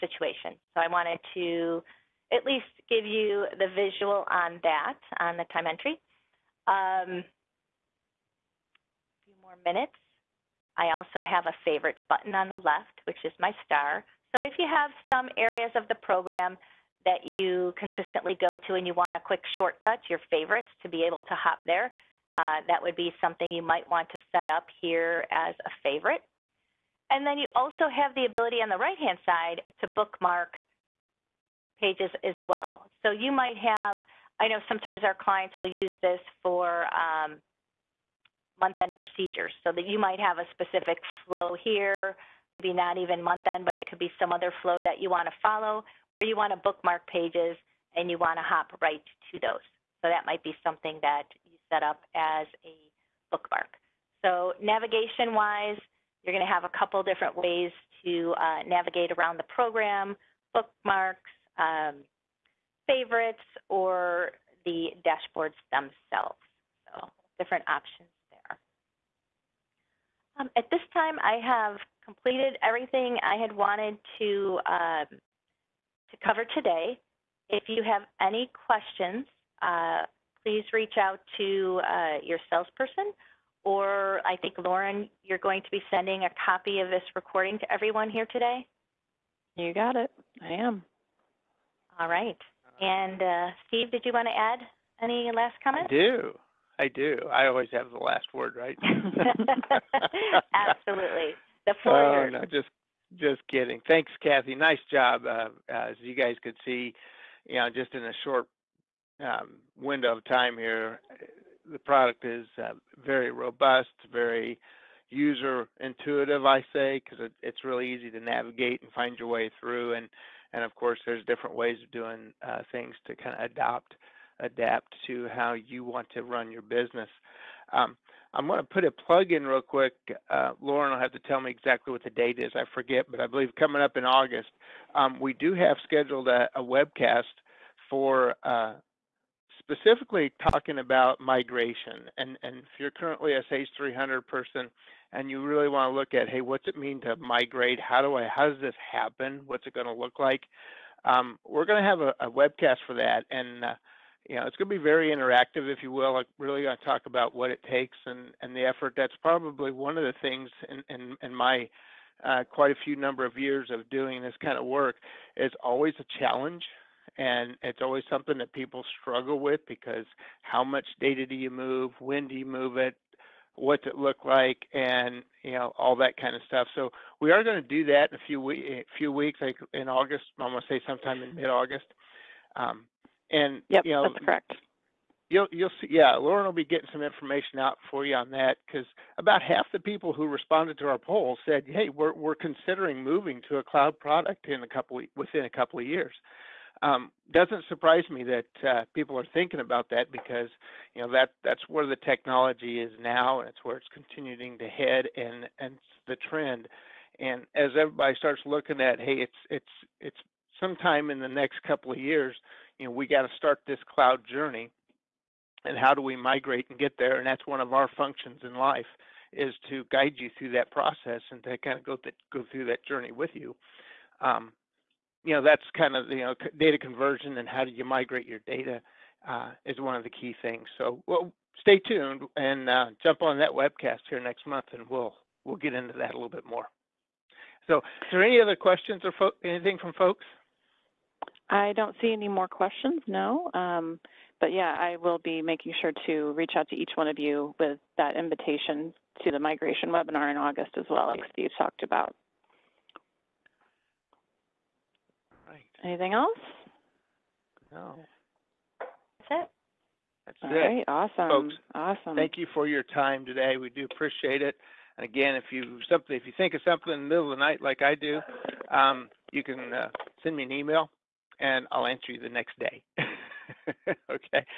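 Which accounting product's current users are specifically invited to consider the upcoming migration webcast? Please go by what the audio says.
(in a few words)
Sage 300.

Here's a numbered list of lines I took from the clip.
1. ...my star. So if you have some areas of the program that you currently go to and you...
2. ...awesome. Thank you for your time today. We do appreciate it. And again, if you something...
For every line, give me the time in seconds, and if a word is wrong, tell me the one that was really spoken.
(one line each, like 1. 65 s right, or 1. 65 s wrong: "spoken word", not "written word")
1. 13 s wrong: "consistently", not "currently"
2. 261 s right.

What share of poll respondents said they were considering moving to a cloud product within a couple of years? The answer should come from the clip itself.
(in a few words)
about half.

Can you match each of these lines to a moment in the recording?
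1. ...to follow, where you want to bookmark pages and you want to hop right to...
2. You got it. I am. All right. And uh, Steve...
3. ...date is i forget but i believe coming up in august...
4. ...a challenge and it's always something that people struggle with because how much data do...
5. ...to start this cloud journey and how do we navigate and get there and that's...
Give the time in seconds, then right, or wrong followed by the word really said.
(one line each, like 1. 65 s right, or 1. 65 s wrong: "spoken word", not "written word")
1. 45 s right
2. 89 s right
3. 132 s right
4. 165 s right
5. 213 s wrong: "migrate", not "navigate".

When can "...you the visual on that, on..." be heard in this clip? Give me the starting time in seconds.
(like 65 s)
3 s.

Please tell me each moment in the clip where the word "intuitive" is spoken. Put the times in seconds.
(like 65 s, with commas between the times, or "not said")
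115 s.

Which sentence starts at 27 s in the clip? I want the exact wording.
And then you also have the ability on the right-hand side to bookmark pages as well.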